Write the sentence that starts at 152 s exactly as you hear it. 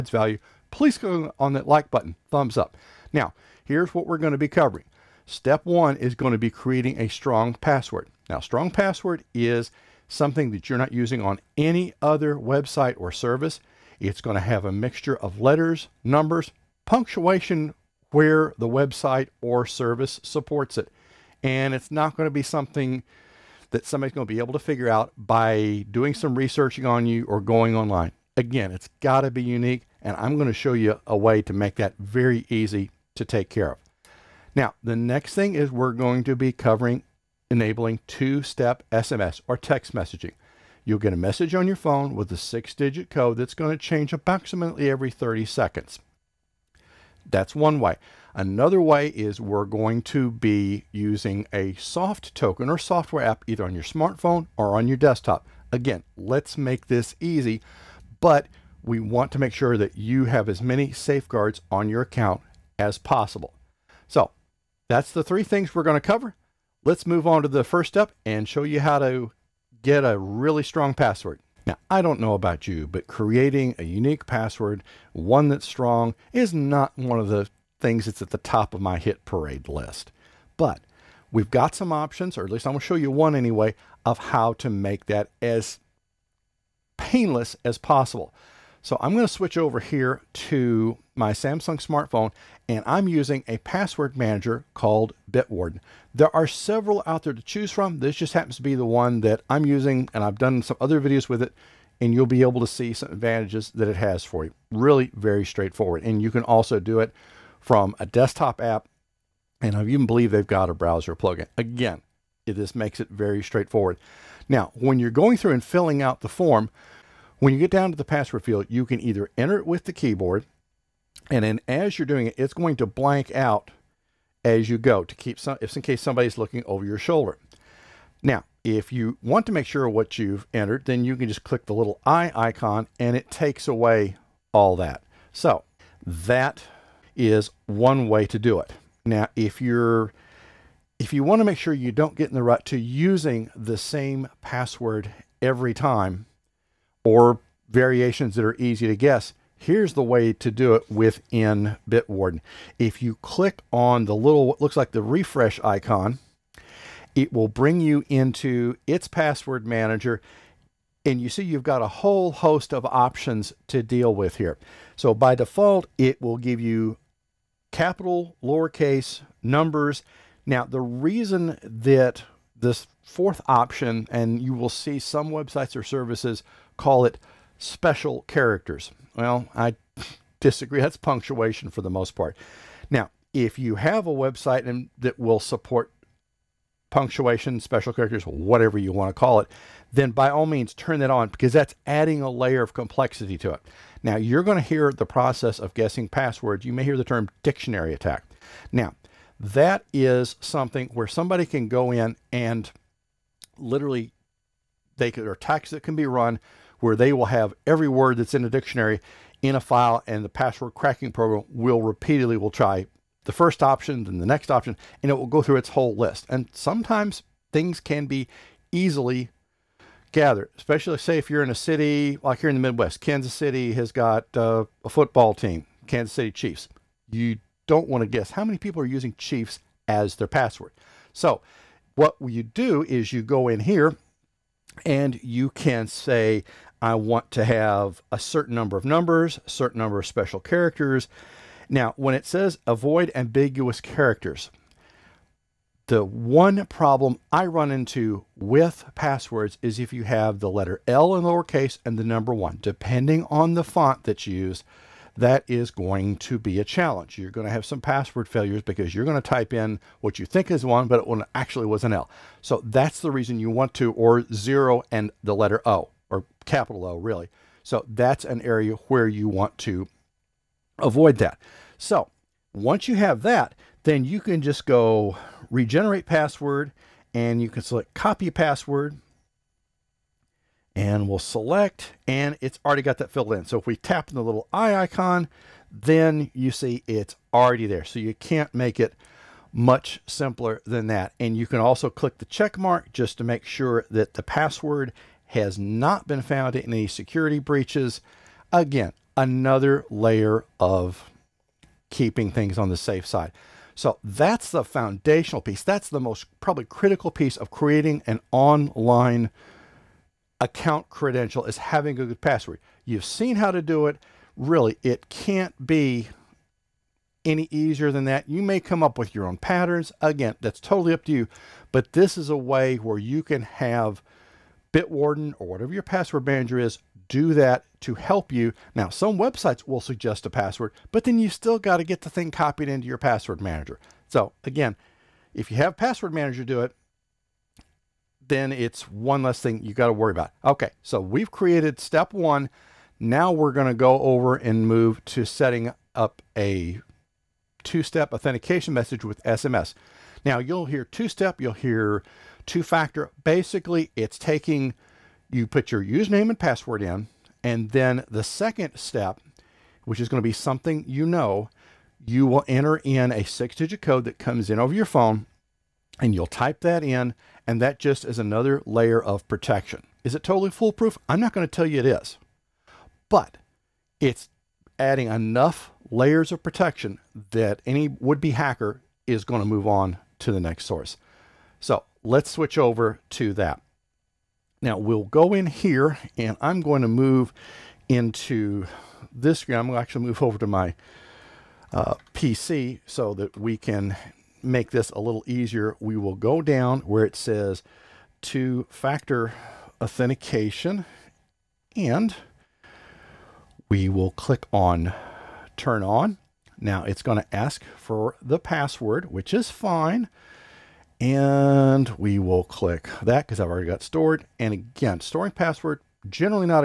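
If you click on the little, what looks like the refresh icon, it will bring you into its password manager.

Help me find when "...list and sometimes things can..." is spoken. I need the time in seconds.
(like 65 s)
215 s.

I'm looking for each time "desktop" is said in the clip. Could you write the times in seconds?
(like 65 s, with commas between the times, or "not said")
54 s, 108 s.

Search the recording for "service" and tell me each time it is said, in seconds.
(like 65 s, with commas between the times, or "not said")
13 s, 19 s, 175 s.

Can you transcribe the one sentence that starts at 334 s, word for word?
So again, if you have password manager do it, then it's one less thing you got to worry about.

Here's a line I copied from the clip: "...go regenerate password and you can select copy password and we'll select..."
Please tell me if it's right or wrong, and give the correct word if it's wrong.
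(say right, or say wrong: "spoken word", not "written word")
right.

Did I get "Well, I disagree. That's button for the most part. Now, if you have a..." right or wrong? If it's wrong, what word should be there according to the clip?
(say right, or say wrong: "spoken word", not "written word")
wrong: "punctuation", not "button".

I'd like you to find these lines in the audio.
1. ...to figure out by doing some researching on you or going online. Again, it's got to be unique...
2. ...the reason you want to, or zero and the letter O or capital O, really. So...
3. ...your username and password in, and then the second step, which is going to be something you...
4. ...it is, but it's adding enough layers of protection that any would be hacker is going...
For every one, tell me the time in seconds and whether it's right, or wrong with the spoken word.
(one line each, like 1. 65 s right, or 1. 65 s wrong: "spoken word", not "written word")
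1. 24 s right
2. 262 s right
3. 355 s right
4. 371 s right.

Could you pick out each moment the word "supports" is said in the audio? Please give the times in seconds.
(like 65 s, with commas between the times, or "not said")
20 s, 185 s.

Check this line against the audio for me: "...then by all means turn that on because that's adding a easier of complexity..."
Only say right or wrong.
wrong.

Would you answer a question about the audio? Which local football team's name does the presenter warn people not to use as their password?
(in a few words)
Kansas City Chiefs.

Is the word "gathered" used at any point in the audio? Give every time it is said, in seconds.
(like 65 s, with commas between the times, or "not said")
220 s.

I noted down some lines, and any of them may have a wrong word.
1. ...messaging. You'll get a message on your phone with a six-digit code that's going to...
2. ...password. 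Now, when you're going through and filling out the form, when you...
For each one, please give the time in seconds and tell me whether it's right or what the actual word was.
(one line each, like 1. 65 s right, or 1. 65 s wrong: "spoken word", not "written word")
1. 39 s right
2. 113 s wrong: "straightforward", not "password".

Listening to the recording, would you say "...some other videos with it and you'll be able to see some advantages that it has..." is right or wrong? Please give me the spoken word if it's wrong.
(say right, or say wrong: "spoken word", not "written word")
right.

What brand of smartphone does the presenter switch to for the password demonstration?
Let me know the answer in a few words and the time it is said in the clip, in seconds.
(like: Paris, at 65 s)
Samsung, at 91 s.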